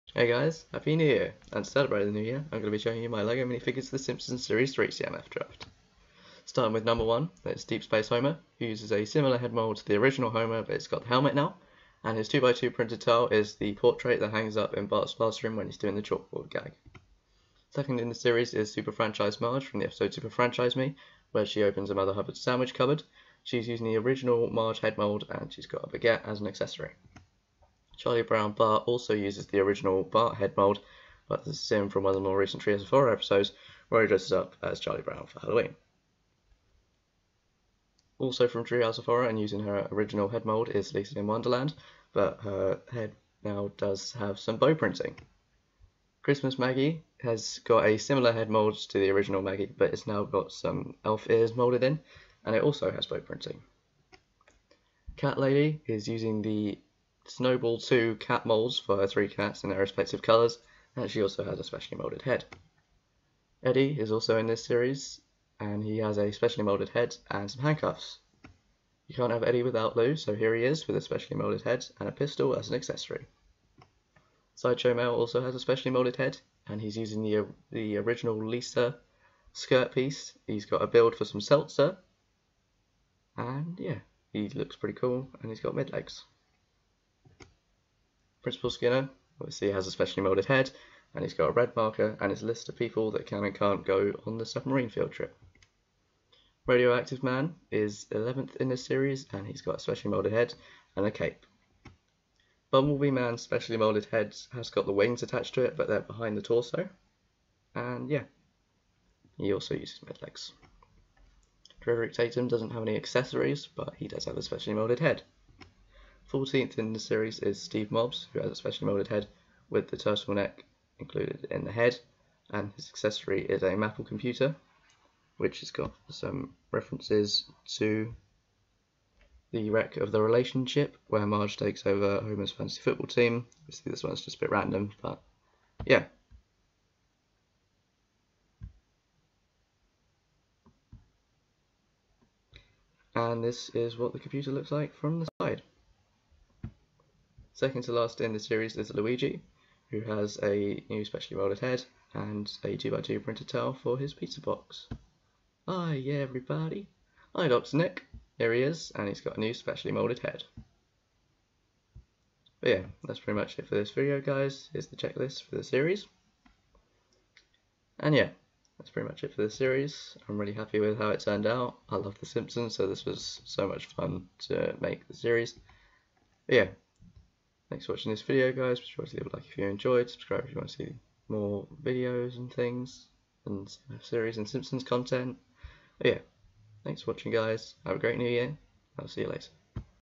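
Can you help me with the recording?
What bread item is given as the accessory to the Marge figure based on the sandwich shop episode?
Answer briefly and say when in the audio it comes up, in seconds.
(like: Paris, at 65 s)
Baguette, at 25 s.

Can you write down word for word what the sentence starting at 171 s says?
I love The Simpsons, so this was so much fun to make the series.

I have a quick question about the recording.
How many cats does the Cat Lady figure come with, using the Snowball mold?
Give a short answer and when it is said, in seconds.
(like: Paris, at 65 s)
3, at 59 s.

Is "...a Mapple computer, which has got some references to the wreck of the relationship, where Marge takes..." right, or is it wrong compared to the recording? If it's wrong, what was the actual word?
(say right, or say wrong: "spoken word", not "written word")
right.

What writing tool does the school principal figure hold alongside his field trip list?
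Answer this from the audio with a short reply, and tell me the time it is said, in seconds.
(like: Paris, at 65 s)
Red marker, at 91 s.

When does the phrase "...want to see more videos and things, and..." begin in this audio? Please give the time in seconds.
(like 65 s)
180 s.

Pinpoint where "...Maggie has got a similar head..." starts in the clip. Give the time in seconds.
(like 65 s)
46 s.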